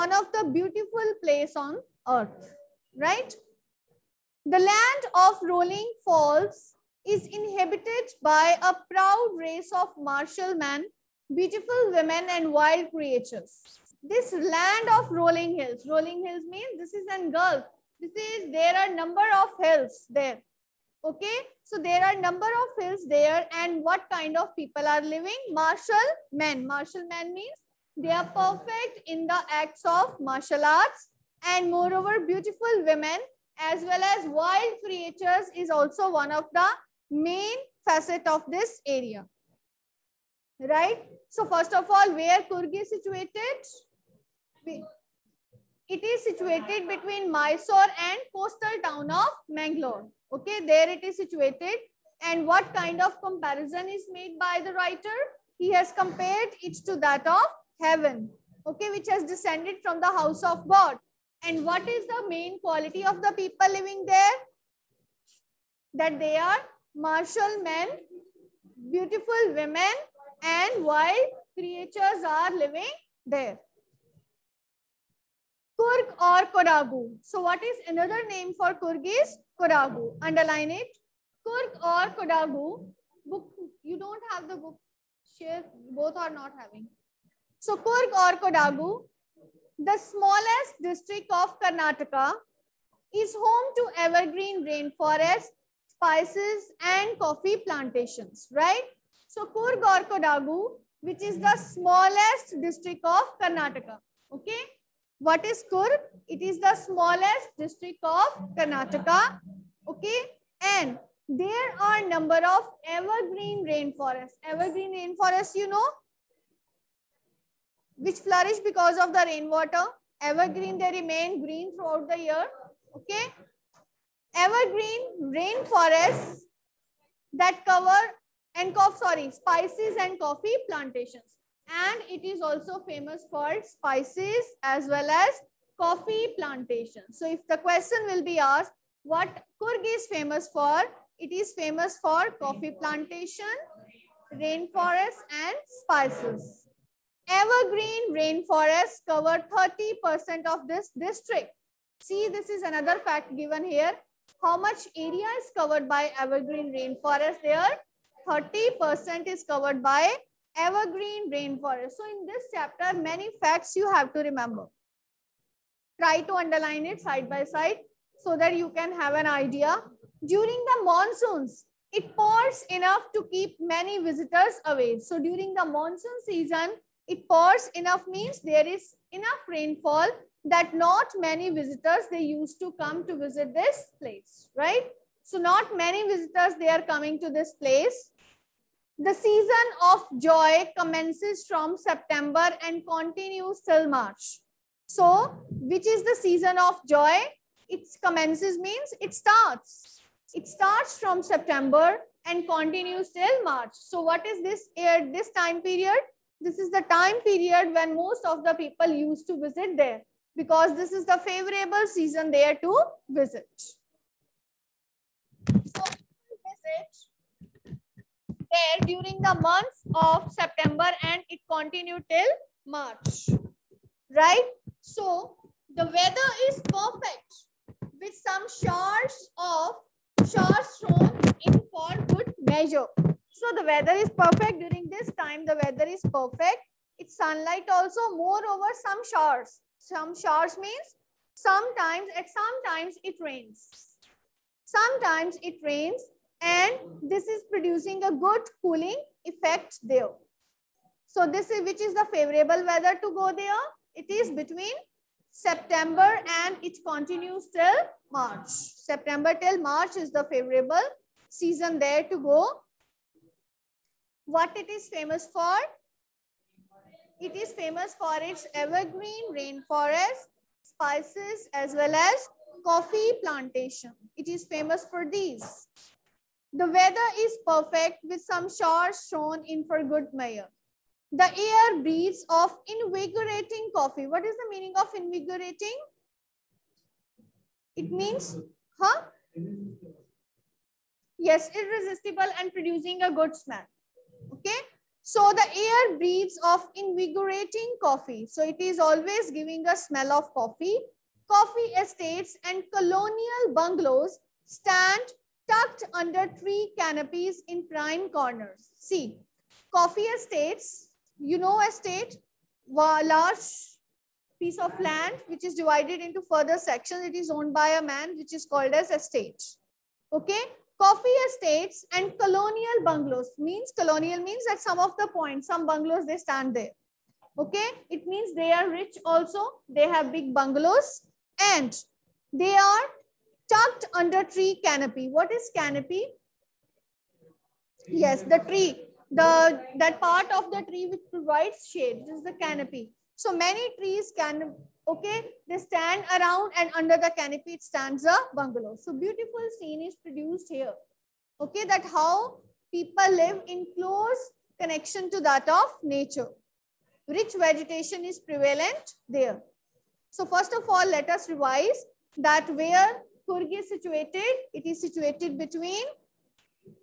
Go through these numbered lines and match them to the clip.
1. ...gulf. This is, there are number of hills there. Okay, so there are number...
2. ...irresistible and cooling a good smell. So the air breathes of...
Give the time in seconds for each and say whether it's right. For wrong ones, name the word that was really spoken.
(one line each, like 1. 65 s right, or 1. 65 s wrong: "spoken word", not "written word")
1. 17 s right
2. 291 s wrong: "producing", not "cooling".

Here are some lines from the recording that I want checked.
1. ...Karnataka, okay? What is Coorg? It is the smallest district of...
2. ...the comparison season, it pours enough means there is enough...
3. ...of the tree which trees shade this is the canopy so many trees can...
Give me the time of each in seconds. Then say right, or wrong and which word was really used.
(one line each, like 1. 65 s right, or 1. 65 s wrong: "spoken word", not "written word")
1. 103 s right
2. 175 s wrong: "monsoon", not "comparison"
3. 340 s wrong: "provides", not "trees".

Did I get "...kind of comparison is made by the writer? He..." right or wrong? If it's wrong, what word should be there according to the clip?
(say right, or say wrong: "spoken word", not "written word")
right.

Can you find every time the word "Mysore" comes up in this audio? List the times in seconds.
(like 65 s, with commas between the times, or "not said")
47 s.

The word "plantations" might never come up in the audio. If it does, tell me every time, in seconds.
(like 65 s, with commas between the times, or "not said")
97 s, 130 s, 136 s, 142 s, 273 s.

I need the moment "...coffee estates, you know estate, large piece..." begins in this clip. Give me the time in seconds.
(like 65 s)
309 s.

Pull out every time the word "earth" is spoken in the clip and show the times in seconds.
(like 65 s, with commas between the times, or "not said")
2 s.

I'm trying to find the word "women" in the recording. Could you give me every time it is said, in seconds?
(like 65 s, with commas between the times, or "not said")
11 s, 32 s, 69 s.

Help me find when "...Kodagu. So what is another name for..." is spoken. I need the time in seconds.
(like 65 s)
76 s.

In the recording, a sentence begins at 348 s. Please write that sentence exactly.
So beautiful scene is produced here.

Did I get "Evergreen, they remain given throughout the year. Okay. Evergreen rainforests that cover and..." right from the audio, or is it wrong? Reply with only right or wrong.
wrong.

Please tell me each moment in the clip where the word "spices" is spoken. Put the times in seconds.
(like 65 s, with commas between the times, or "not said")
95 s, 129 s, 133 s, 145 s, 270 s.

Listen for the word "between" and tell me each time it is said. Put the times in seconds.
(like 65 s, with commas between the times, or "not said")
46 s, 254 s, 365 s.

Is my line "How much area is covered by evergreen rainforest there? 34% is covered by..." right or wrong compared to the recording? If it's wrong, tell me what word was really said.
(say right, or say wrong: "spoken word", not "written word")
wrong: "30", not "34".